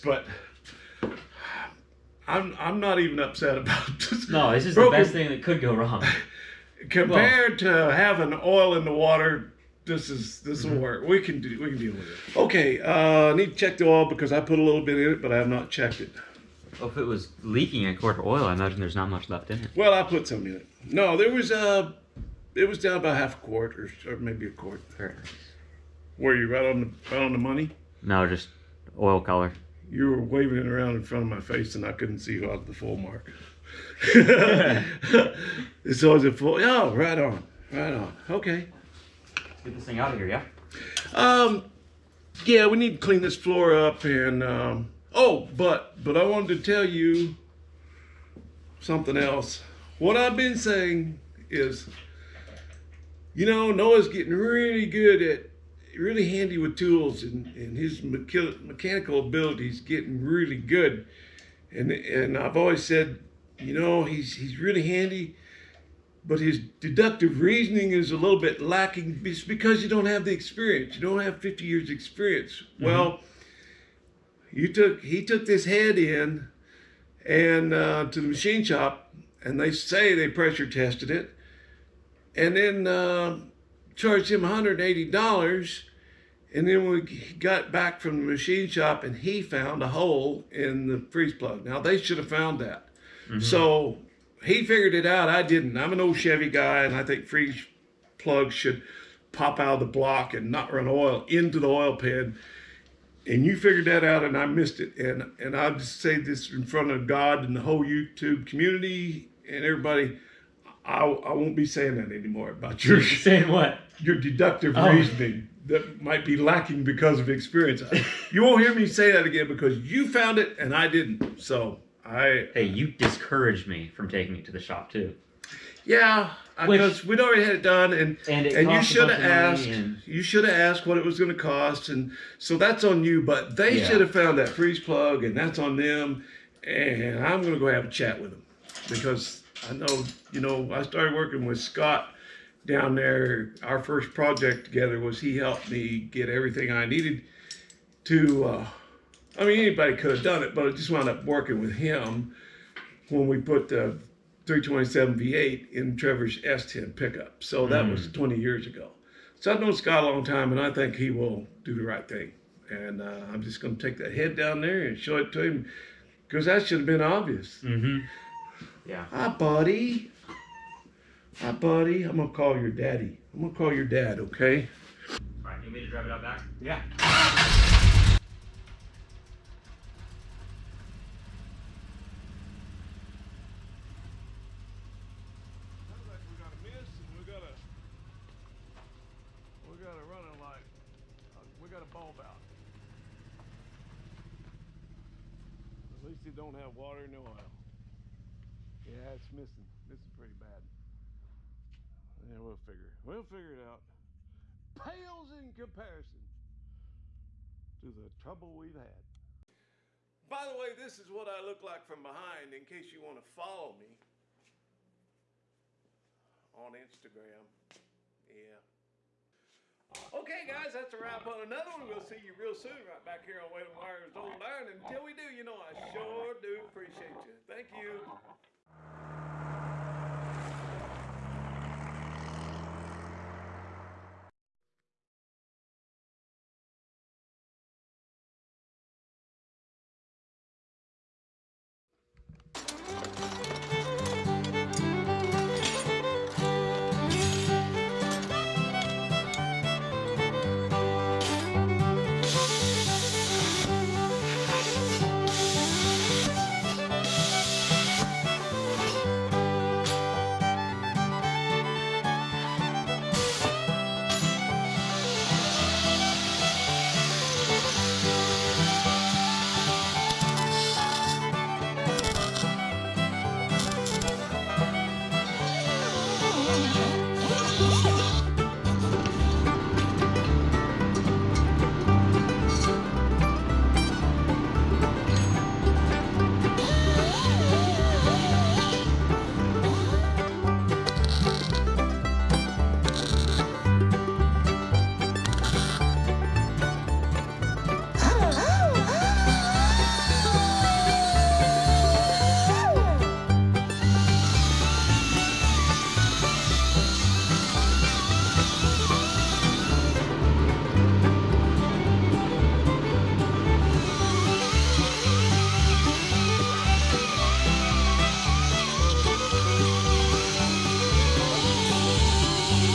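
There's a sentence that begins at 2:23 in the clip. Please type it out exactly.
Our first project together was he helped me get everything I needed to.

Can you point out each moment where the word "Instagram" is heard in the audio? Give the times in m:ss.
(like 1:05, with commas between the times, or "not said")
3:36.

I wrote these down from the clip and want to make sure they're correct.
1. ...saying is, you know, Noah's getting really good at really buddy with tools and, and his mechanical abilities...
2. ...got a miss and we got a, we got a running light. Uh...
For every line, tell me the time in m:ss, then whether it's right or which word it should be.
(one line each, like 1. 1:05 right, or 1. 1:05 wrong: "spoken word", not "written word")
1. 0:50 wrong: "handy", not "buddy"
2. 3:06 right.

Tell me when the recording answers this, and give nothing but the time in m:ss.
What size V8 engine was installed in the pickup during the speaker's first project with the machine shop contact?
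2:34.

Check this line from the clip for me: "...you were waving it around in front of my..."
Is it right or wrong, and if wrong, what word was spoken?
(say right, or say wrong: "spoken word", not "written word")
right.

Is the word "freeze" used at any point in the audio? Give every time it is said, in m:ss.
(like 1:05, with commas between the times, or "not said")
1:31, 1:37, 2:14.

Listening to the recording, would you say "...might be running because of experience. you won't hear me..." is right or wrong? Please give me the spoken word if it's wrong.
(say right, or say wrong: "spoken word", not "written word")
wrong: "lacking", not "running".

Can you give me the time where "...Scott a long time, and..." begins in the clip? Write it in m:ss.
2:39.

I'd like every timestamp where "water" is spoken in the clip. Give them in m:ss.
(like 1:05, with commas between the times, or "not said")
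0:08, 3:16.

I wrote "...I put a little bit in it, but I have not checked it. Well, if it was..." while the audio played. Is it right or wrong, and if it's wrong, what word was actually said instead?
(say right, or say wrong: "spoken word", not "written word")
right.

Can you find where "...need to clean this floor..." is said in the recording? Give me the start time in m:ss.
0:42.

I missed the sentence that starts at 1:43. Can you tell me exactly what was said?
And you figured that out and I missed it.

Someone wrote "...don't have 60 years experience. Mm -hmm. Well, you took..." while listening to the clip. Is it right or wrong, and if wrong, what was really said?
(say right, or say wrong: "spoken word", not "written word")
wrong: "50", not "60".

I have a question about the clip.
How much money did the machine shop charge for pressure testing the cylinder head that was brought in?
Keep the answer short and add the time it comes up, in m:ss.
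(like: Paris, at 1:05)
$180, at 1:24.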